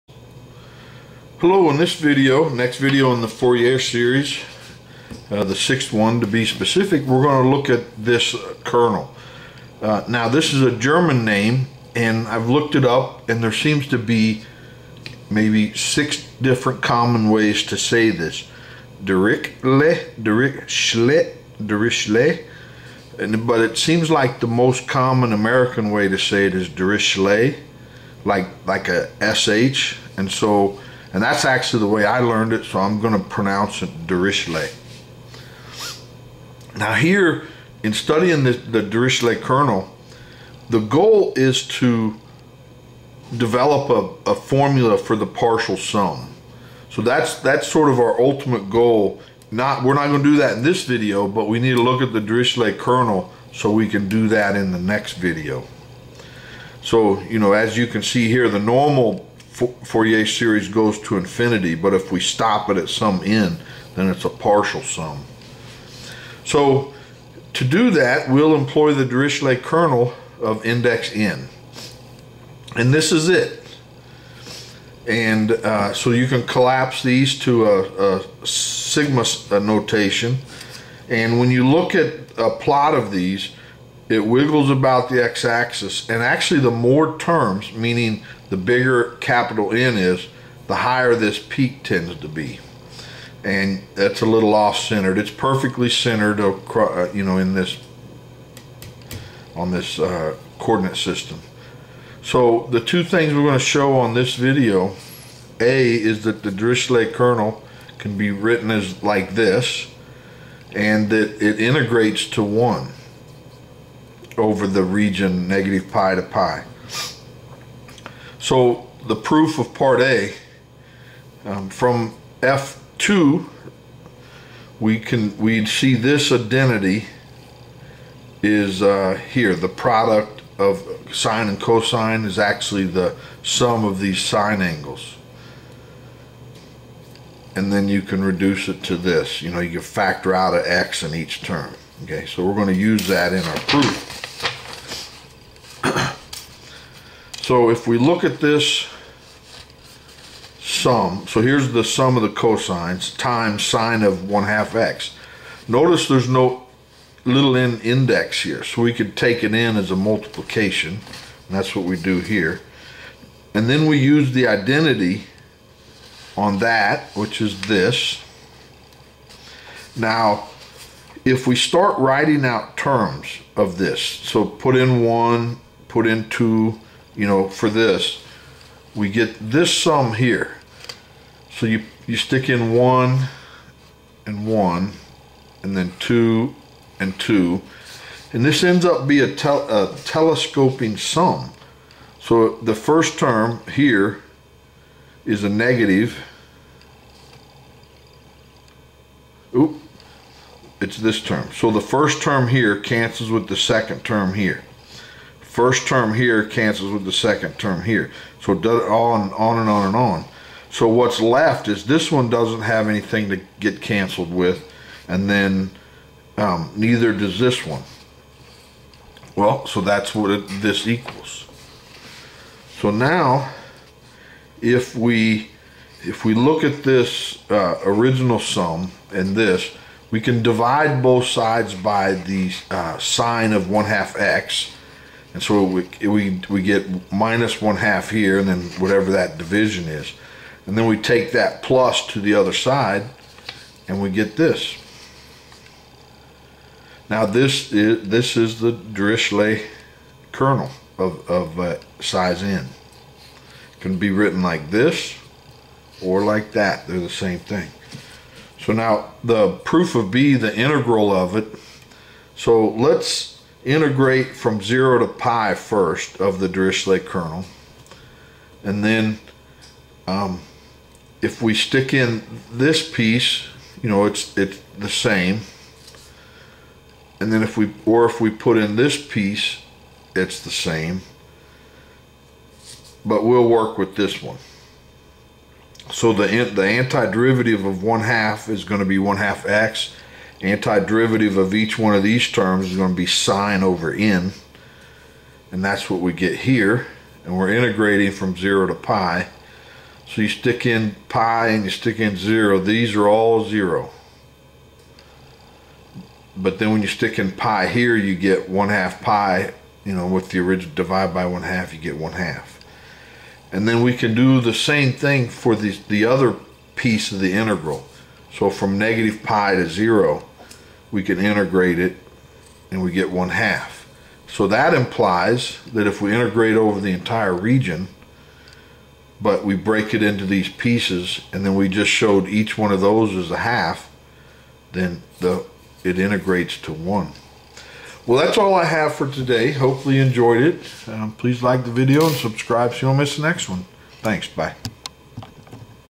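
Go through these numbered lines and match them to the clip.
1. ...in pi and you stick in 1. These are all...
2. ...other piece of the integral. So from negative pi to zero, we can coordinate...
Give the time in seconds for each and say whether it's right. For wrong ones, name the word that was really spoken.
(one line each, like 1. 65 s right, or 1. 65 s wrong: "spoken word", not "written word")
1. 300 s wrong: "0", not "1"
2. 316 s wrong: "integrate", not "coordinate".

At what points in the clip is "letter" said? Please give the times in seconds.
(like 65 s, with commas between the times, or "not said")
not said.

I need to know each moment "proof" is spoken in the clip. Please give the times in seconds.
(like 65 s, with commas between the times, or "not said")
119 s, 143 s, 259 s.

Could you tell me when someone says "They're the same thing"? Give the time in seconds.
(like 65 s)
256 s.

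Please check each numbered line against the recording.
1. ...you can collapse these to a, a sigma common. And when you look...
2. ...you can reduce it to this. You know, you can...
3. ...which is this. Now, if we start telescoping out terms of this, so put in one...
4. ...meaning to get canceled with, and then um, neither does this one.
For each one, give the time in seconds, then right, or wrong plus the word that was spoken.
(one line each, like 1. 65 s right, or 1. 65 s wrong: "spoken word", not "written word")
1. 76 s wrong: "notation", not "common"
2. 137 s right
3. 167 s wrong: "writing", not "telescoping"
4. 212 s wrong: "anything", not "meaning".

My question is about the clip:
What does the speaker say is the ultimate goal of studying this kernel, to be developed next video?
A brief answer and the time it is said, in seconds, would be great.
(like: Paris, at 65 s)
a formula for the partial sum, at 44 s.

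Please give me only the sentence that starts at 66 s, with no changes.
So to do that, we'll employ the Dirichlet kernel of index n.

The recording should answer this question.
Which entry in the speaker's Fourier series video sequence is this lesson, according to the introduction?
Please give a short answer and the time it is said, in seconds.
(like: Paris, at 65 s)
sixth, at 5 s.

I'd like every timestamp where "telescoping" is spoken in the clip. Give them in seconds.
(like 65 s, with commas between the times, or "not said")
189 s.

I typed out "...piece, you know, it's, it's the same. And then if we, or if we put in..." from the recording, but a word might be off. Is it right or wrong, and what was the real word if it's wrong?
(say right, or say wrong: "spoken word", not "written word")
right.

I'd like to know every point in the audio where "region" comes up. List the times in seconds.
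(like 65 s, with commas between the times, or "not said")
114 s, 327 s.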